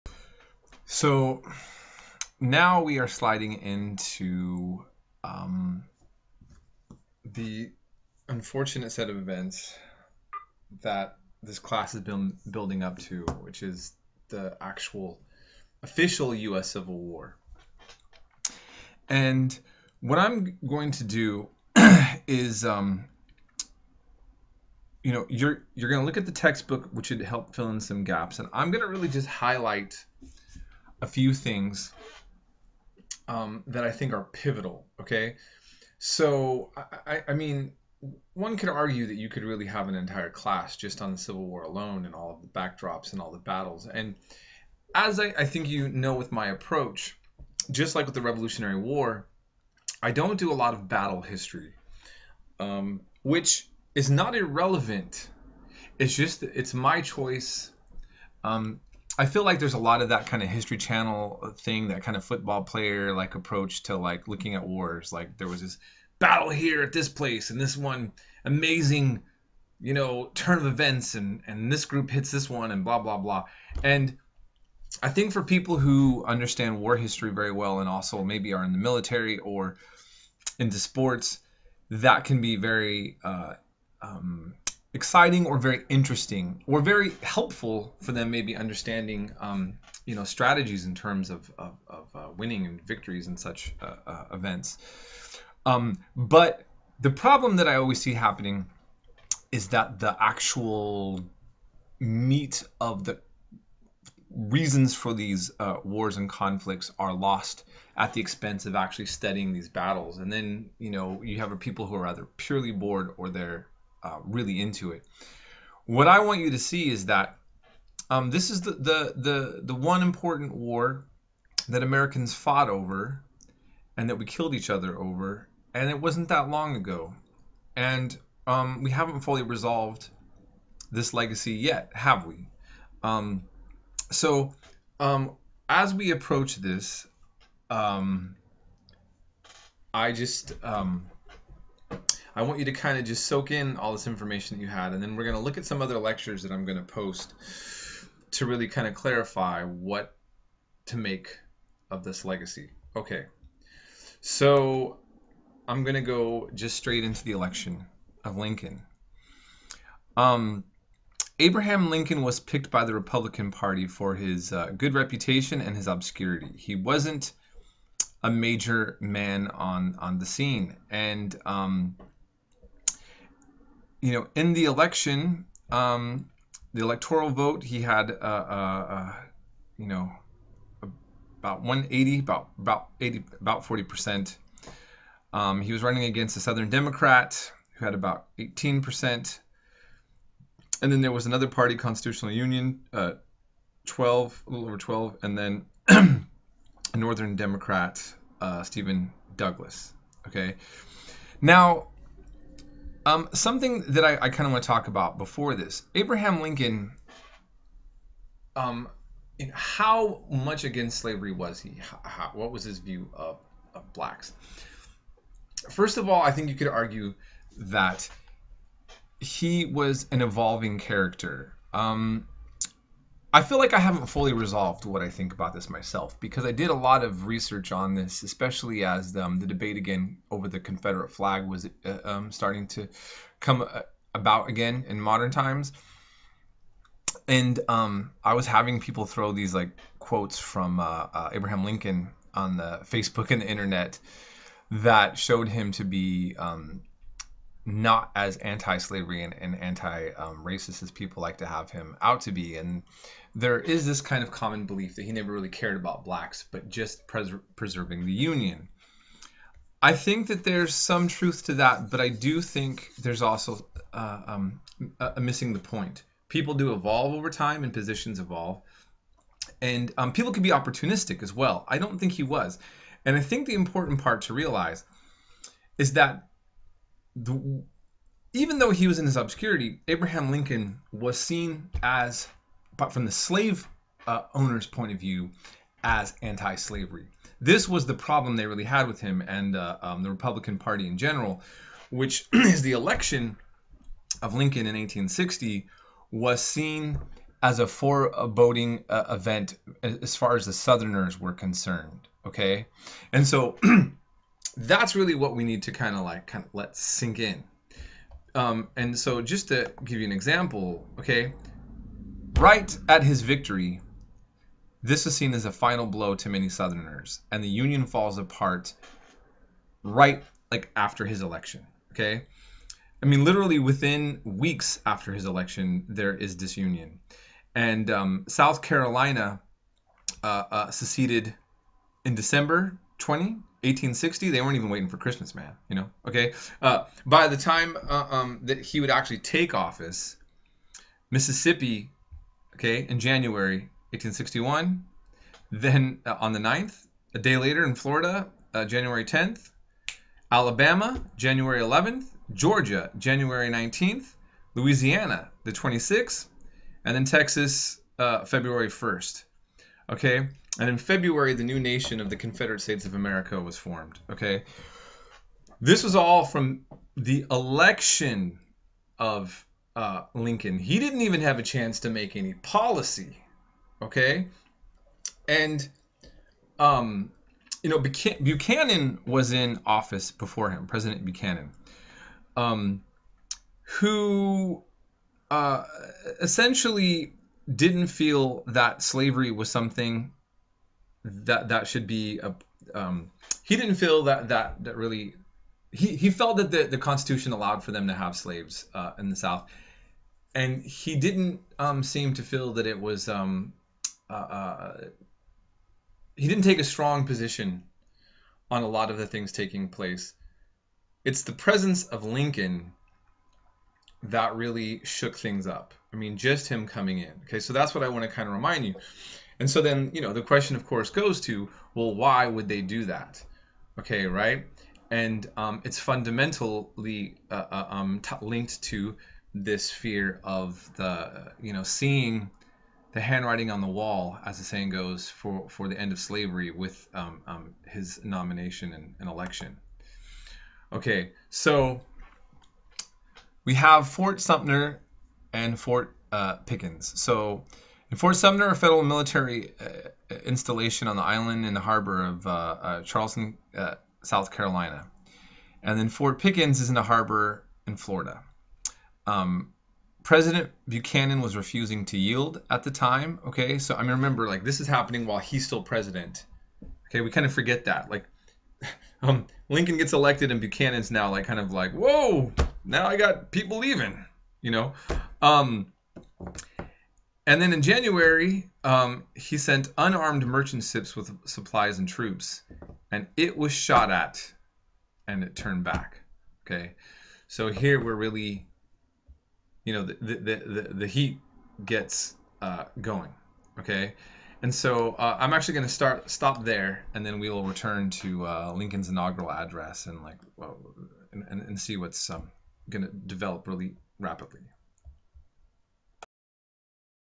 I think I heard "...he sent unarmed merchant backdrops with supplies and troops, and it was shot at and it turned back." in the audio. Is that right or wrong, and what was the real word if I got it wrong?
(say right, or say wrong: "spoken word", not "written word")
wrong: "ships", not "backdrops".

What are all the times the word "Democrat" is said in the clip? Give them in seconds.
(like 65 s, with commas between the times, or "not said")
186 s, 197 s.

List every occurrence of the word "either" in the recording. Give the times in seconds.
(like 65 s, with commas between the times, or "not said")
112 s.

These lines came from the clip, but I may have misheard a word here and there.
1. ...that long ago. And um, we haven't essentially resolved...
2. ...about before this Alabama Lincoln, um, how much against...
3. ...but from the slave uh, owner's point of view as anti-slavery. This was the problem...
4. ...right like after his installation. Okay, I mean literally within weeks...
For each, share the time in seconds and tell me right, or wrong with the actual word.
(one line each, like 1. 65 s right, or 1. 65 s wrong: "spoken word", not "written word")
1. 126 s wrong: "fully", not "essentially"
2. 204 s wrong: "Abraham", not "Alabama"
3. 282 s right
4. 319 s wrong: "election", not "installation".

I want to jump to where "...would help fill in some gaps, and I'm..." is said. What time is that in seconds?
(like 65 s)
27 s.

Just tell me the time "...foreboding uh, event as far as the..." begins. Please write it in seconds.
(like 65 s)
297 s.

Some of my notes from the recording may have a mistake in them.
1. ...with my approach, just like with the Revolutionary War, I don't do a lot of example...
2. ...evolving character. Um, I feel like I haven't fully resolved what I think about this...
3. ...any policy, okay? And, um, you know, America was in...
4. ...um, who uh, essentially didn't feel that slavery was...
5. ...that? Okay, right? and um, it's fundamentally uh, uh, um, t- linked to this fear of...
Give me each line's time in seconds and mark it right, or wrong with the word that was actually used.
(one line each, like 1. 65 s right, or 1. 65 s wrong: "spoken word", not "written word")
1. 46 s wrong: "battle", not "example"
2. 220 s right
3. 372 s wrong: "Buchanan", not "America"
4. 382 s right
5. 422 s right.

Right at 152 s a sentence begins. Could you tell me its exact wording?
Okay, so I'm going to go just straight into the election of Lincoln.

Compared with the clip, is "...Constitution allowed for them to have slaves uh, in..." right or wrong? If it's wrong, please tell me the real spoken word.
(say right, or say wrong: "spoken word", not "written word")
right.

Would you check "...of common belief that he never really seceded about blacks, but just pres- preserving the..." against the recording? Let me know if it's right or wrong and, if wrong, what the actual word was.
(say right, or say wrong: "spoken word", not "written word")
wrong: "cared", not "seceded".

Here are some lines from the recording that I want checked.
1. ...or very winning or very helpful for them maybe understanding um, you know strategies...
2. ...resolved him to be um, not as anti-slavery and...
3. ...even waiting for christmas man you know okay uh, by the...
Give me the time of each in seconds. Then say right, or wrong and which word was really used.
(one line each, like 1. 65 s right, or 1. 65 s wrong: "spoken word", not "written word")
1. 85 s wrong: "interesting", not "winning"
2. 245 s wrong: "showed", not "resolved"
3. 334 s right.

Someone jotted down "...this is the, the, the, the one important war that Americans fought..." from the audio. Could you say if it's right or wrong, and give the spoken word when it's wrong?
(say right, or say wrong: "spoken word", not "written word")
right.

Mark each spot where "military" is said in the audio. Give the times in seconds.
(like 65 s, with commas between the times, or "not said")
78 s, 448 s.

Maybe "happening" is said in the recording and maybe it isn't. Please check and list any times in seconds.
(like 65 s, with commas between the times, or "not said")
98 s, 464 s.